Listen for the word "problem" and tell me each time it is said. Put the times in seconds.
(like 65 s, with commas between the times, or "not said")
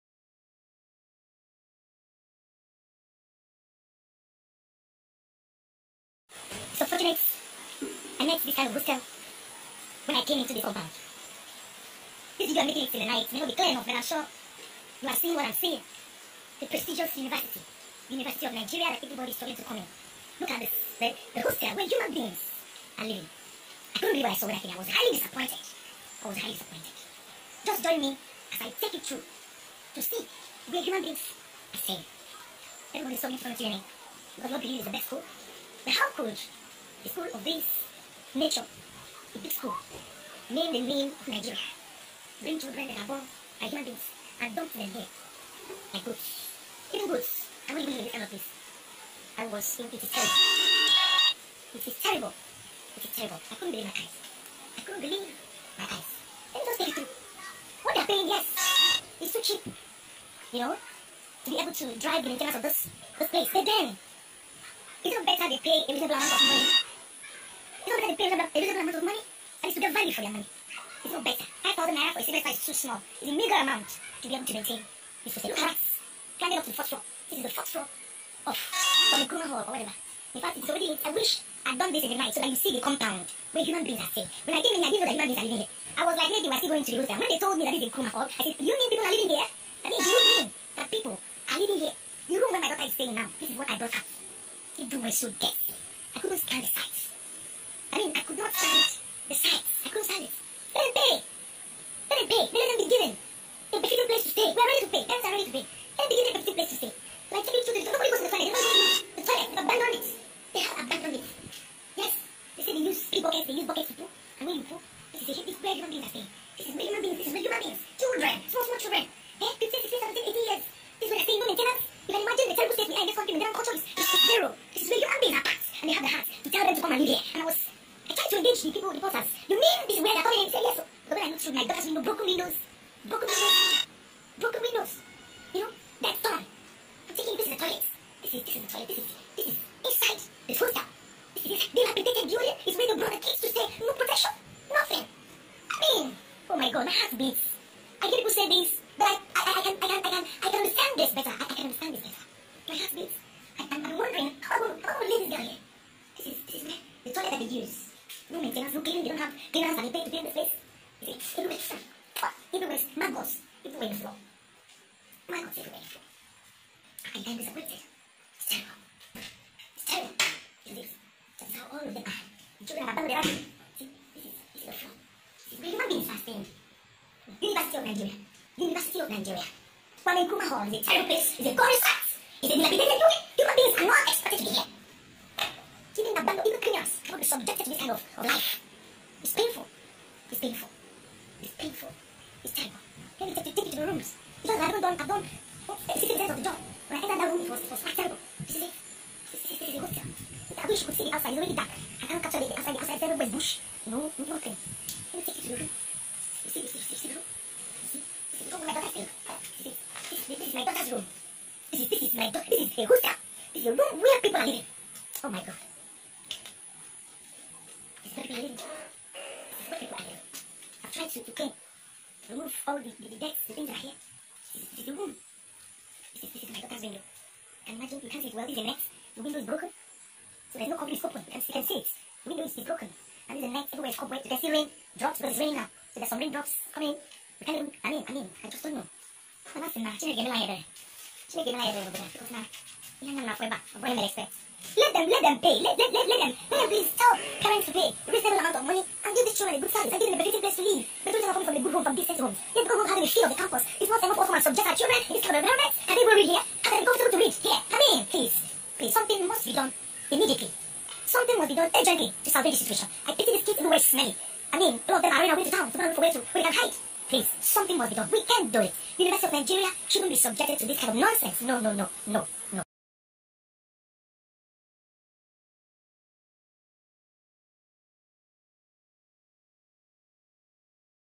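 231 s.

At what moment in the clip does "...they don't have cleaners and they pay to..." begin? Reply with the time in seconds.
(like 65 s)
159 s.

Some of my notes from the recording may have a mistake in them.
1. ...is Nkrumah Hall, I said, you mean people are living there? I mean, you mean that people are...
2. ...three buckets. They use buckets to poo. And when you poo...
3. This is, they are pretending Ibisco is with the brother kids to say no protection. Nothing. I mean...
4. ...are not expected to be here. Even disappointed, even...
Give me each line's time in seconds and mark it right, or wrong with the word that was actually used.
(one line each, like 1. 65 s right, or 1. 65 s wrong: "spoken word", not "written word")
1. 87 s right
2. 113 s right
3. 141 s wrong: "Julia", not "Ibisco"
4. 183 s wrong: "abandoned", not "disappointed".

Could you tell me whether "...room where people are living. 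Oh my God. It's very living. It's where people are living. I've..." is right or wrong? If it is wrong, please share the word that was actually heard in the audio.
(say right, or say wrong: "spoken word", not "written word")
right.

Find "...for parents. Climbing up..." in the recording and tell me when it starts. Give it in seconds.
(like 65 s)
75 s.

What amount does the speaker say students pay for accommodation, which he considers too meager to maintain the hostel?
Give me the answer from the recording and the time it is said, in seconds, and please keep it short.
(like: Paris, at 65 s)
5,000 naira, at 71 s.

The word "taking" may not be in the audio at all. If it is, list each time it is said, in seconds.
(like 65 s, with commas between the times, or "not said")
107 s, 137 s.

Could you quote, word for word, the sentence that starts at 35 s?
But how could the school of these Nature, Ibisco, name the name of Nigeria.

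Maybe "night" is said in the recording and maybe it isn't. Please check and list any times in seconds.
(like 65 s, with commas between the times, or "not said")
13 s, 82 s.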